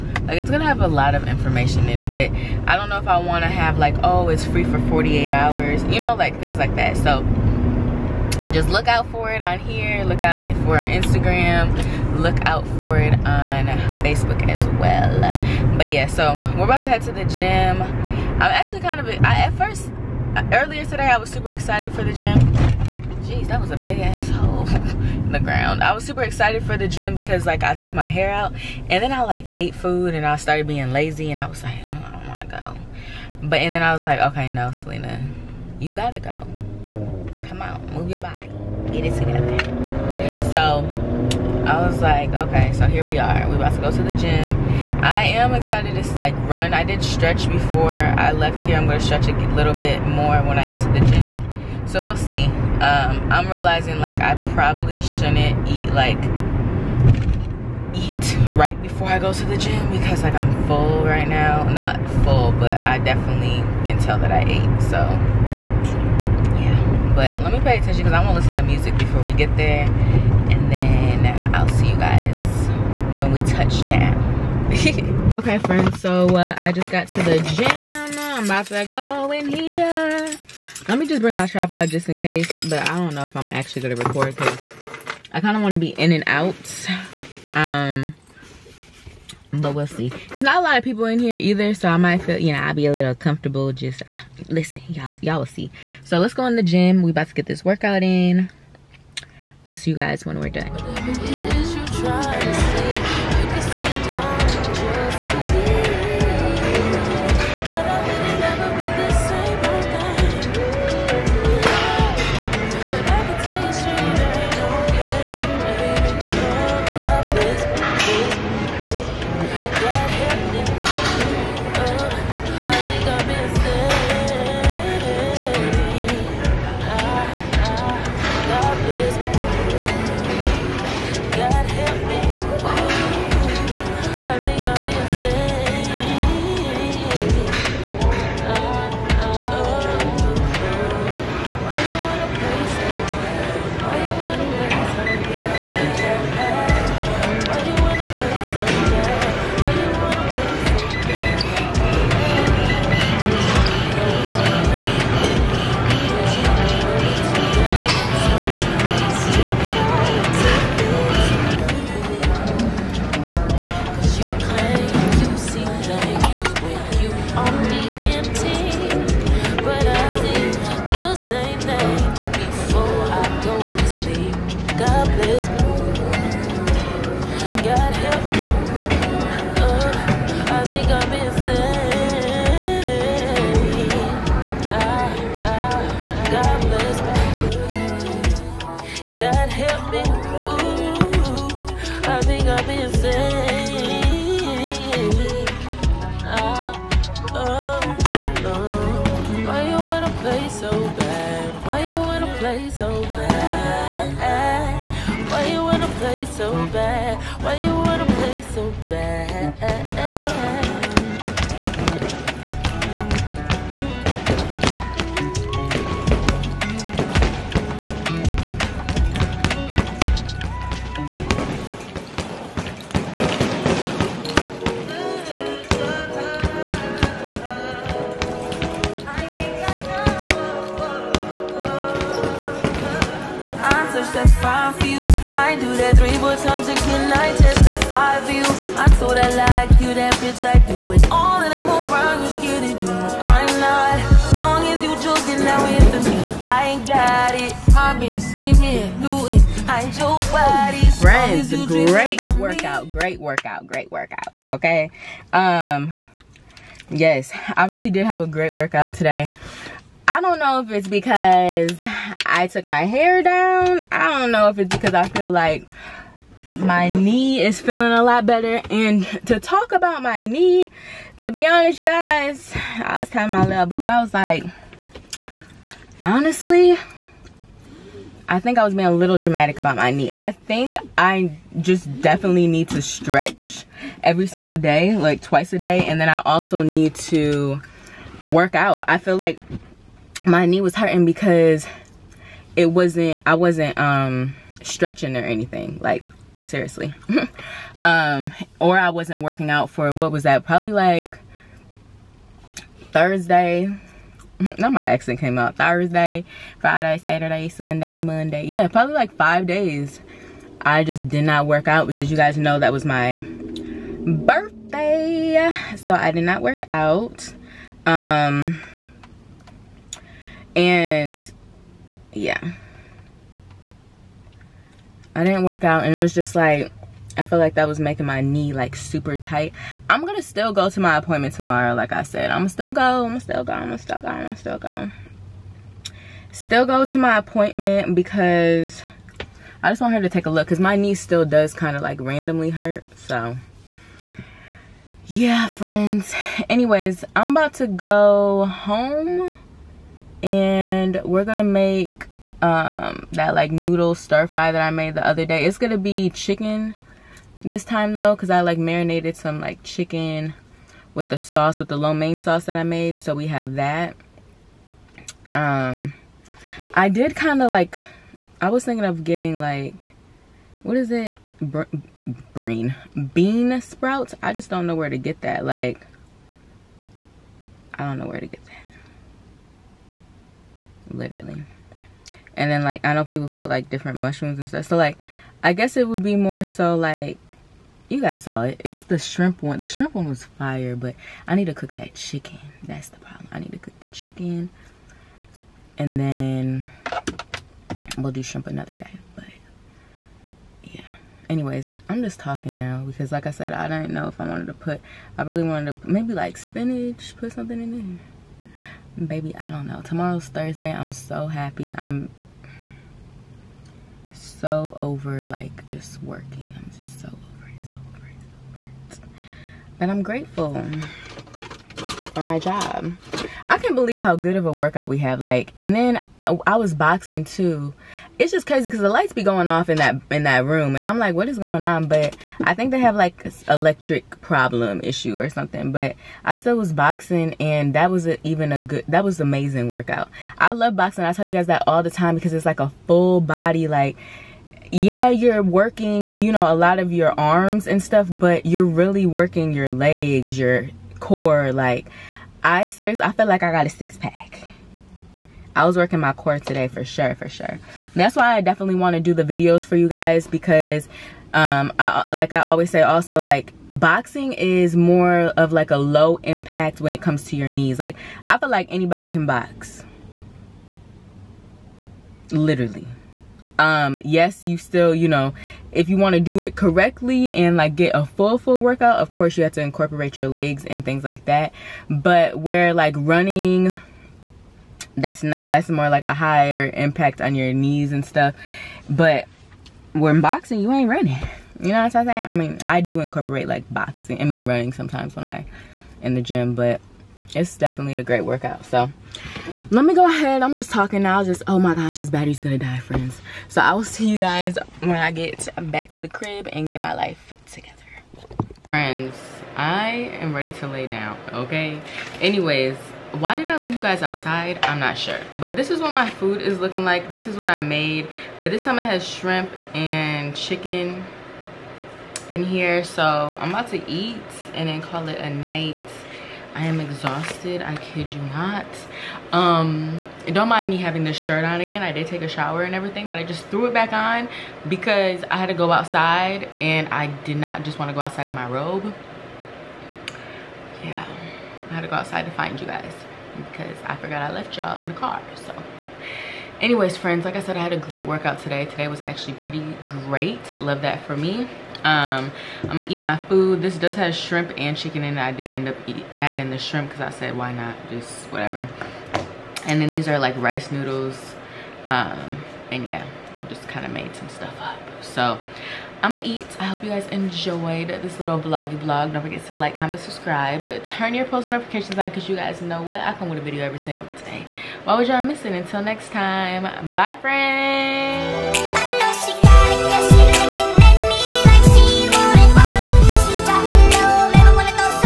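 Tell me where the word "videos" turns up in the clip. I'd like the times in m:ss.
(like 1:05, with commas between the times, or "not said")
7:39, 9:33.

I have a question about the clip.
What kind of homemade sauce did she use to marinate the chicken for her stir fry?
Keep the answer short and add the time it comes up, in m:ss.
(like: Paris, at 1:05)
lo mein sauce, at 6:01.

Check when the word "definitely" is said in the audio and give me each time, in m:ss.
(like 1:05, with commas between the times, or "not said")
1:02, 4:42, 7:38, 8:17.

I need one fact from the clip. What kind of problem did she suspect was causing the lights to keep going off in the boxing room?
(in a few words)
electric problem.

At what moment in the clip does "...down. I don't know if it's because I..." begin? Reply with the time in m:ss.
4:23.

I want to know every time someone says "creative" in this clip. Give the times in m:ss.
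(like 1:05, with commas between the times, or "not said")
not said.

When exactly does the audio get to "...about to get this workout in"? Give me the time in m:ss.
1:37.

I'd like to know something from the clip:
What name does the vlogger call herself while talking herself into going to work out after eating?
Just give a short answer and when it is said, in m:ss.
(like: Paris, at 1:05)
Celina, at 0:34.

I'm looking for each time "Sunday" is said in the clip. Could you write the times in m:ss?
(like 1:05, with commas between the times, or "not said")
5:07.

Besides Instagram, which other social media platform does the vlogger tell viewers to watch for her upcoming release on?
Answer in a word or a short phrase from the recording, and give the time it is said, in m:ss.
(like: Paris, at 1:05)
Facebook, at 0:14.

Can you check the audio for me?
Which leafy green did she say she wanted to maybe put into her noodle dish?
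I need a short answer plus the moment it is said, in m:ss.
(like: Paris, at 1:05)
spinach, at 6:46.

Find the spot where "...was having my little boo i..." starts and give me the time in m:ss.
4:33.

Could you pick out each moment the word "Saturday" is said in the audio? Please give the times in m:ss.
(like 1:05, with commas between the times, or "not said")
5:07.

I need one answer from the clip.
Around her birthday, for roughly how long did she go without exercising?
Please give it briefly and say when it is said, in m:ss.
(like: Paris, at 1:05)
5 days, at 5:09.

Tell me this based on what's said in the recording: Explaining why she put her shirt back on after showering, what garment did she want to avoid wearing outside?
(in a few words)
robe.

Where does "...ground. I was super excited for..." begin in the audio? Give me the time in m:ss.
0:25.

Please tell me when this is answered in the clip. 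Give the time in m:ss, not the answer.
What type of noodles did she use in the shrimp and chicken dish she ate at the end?
9:20.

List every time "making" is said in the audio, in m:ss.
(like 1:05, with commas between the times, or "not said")
5:27.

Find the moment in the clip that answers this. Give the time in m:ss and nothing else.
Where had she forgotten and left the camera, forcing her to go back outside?
9:04.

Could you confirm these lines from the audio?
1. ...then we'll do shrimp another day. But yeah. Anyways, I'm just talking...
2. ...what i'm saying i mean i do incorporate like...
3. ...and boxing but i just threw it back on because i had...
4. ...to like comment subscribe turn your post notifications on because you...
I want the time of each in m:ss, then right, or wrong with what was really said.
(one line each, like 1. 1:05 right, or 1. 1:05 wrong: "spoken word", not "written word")
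1. 6:35 right
2. 8:11 right
3. 8:52 wrong: "everything", not "boxing"
4. 9:29 right.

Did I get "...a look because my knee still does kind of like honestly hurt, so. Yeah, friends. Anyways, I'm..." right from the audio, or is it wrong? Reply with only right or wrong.
wrong.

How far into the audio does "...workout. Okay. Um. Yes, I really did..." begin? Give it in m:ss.
4:13.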